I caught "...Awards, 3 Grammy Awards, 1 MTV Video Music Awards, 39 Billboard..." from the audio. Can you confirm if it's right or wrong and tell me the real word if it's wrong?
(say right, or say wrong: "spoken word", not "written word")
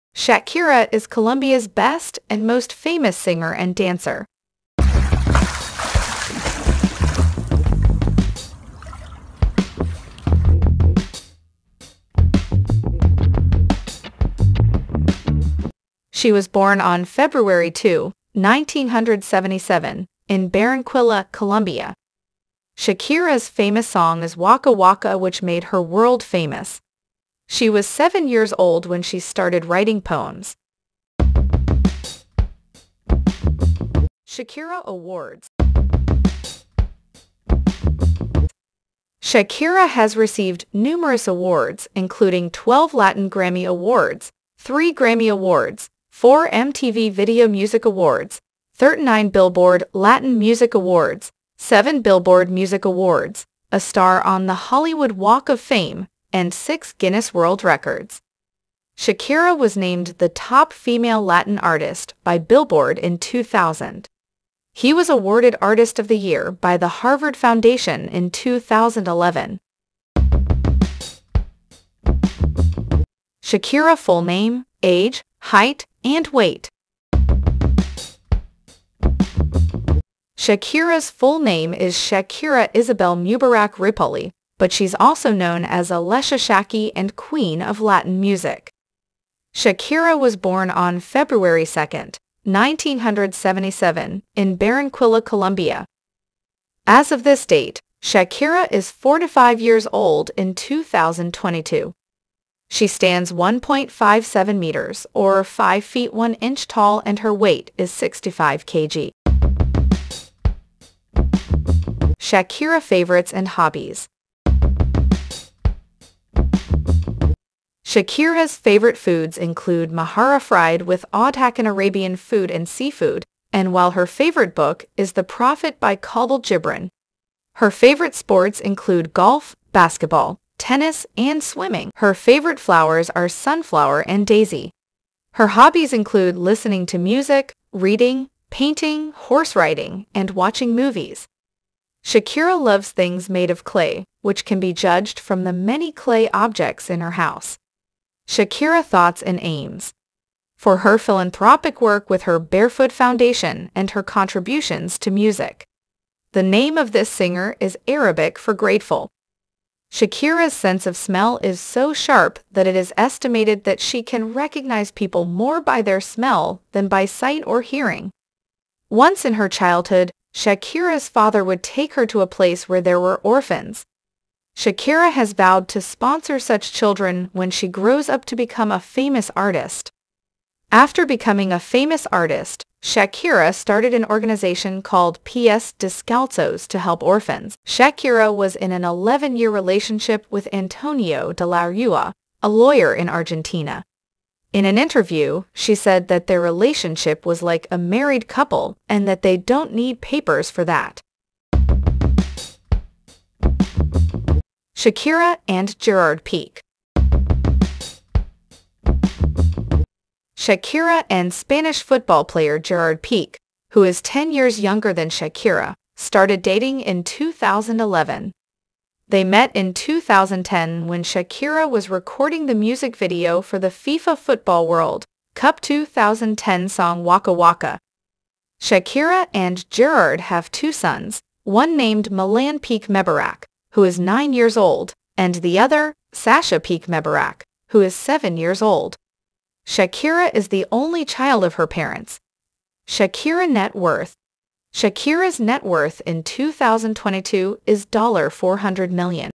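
wrong: "4", not "1".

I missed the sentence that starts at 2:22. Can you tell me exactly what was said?
Shakira loves things made of clay, which can be judged from the many clay objects in her house.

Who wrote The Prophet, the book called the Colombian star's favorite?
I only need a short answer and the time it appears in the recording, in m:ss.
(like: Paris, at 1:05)
Khalil Gibran, at 2:05.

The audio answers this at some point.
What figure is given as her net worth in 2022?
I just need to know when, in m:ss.
4:07.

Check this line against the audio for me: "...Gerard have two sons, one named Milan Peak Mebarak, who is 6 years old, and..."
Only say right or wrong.
wrong.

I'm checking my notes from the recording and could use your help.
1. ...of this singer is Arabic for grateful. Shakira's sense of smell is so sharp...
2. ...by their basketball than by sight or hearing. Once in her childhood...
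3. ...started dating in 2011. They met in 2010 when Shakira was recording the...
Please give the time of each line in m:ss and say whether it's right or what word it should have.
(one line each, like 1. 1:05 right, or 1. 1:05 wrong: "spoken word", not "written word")
1. 2:36 right
2. 2:45 wrong: "smell", not "basketball"
3. 3:35 right.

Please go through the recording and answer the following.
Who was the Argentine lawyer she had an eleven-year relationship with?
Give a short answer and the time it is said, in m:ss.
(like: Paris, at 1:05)
Antonio de la Rua, at 3:10.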